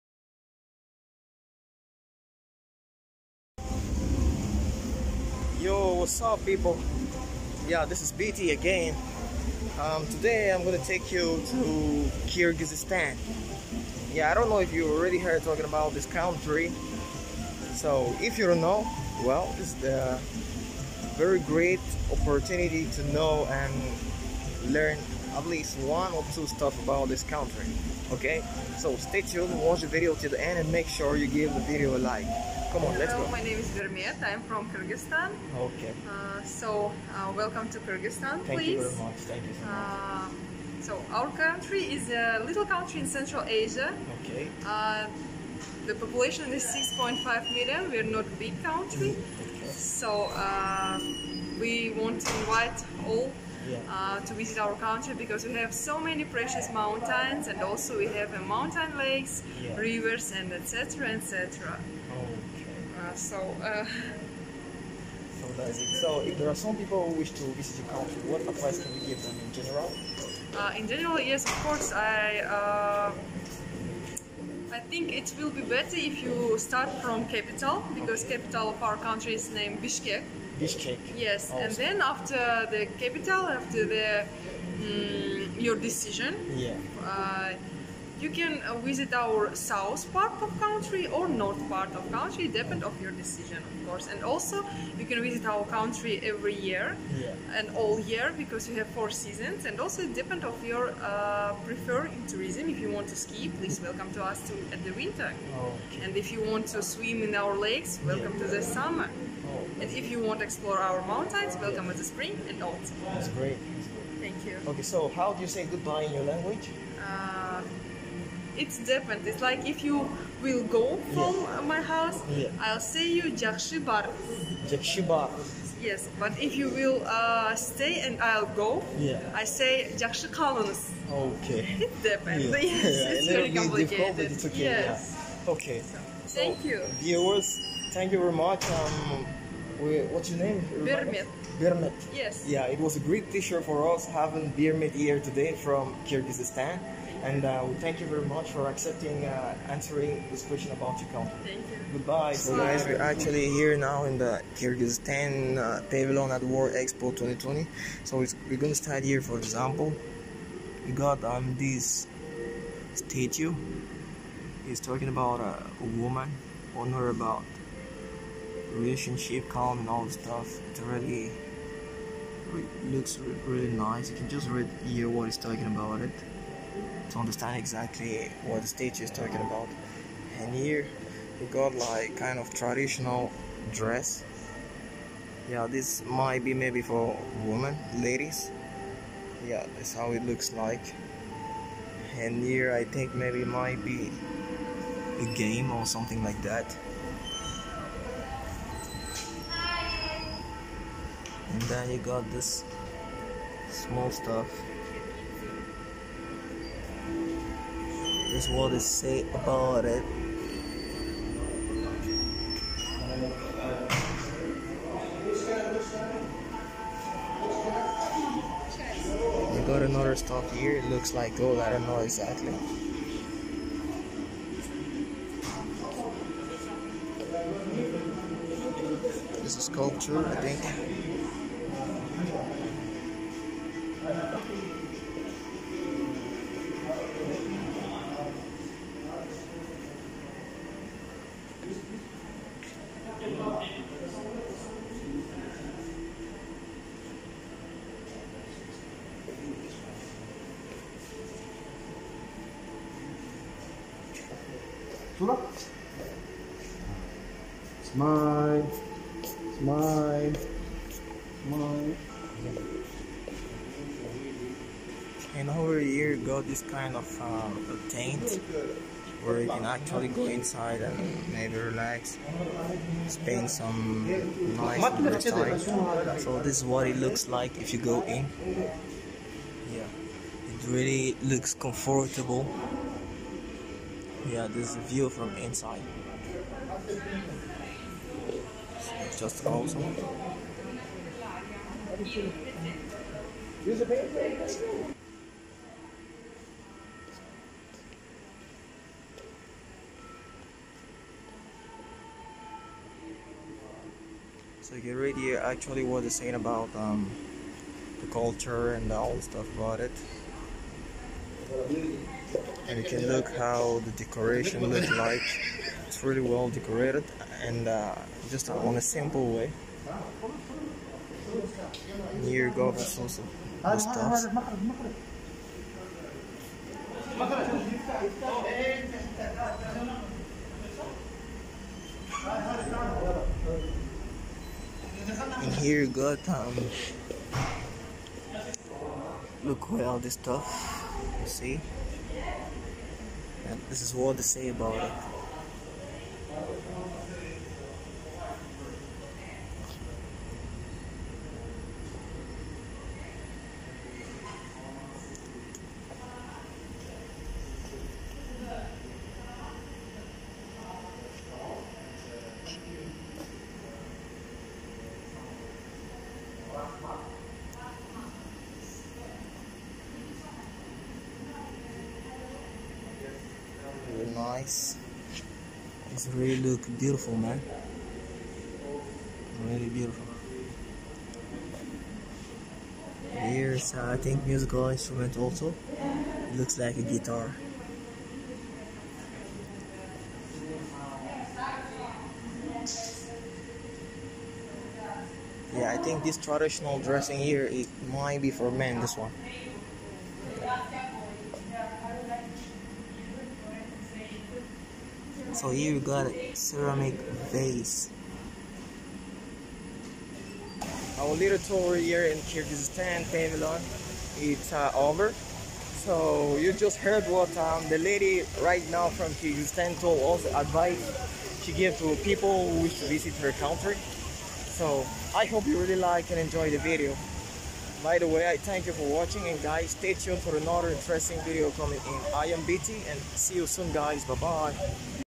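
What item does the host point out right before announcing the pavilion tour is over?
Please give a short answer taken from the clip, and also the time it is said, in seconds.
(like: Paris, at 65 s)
ceramic vase, at 406 s.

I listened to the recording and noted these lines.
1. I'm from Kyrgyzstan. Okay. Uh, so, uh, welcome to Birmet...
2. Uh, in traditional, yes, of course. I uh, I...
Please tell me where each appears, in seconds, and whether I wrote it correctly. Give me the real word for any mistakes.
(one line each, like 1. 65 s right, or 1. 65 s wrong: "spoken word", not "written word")
1. 34 s wrong: "Kyrgyzstan", not "Birmet"
2. 70 s wrong: "general", not "traditional".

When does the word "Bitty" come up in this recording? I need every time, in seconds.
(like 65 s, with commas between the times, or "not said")
8 s, 432 s.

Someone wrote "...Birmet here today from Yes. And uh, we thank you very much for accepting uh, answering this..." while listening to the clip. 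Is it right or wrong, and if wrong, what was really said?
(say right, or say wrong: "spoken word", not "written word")
wrong: "Kyrgyzstan", not "Yes".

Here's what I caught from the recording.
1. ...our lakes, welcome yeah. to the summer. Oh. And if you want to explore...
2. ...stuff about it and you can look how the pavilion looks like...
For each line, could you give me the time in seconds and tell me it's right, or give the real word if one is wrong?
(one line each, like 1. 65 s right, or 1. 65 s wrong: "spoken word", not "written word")
1. 107 s right
2. 309 s wrong: "decoration", not "pavilion".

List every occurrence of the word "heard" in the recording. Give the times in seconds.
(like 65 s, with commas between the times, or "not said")
15 s, 416 s.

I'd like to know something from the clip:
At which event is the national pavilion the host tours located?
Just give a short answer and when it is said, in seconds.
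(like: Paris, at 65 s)
World Expo 2020, at 156 s.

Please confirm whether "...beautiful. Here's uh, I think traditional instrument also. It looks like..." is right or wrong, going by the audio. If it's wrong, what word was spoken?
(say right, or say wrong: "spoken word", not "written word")
wrong: "musical", not "traditional".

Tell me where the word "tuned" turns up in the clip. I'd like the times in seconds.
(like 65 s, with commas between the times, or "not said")
29 s, 429 s.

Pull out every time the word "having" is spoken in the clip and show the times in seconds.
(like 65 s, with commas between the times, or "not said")
144 s.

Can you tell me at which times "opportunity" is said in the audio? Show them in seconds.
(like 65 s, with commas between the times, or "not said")
22 s.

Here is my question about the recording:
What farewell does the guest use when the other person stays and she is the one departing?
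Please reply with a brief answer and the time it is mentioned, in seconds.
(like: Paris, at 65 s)
Jakshi Kalınız, at 130 s.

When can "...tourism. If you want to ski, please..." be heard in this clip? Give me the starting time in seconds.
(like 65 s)
102 s.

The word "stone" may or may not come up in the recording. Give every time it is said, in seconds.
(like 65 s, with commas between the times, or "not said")
not said.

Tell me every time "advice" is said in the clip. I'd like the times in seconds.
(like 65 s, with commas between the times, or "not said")
68 s, 420 s.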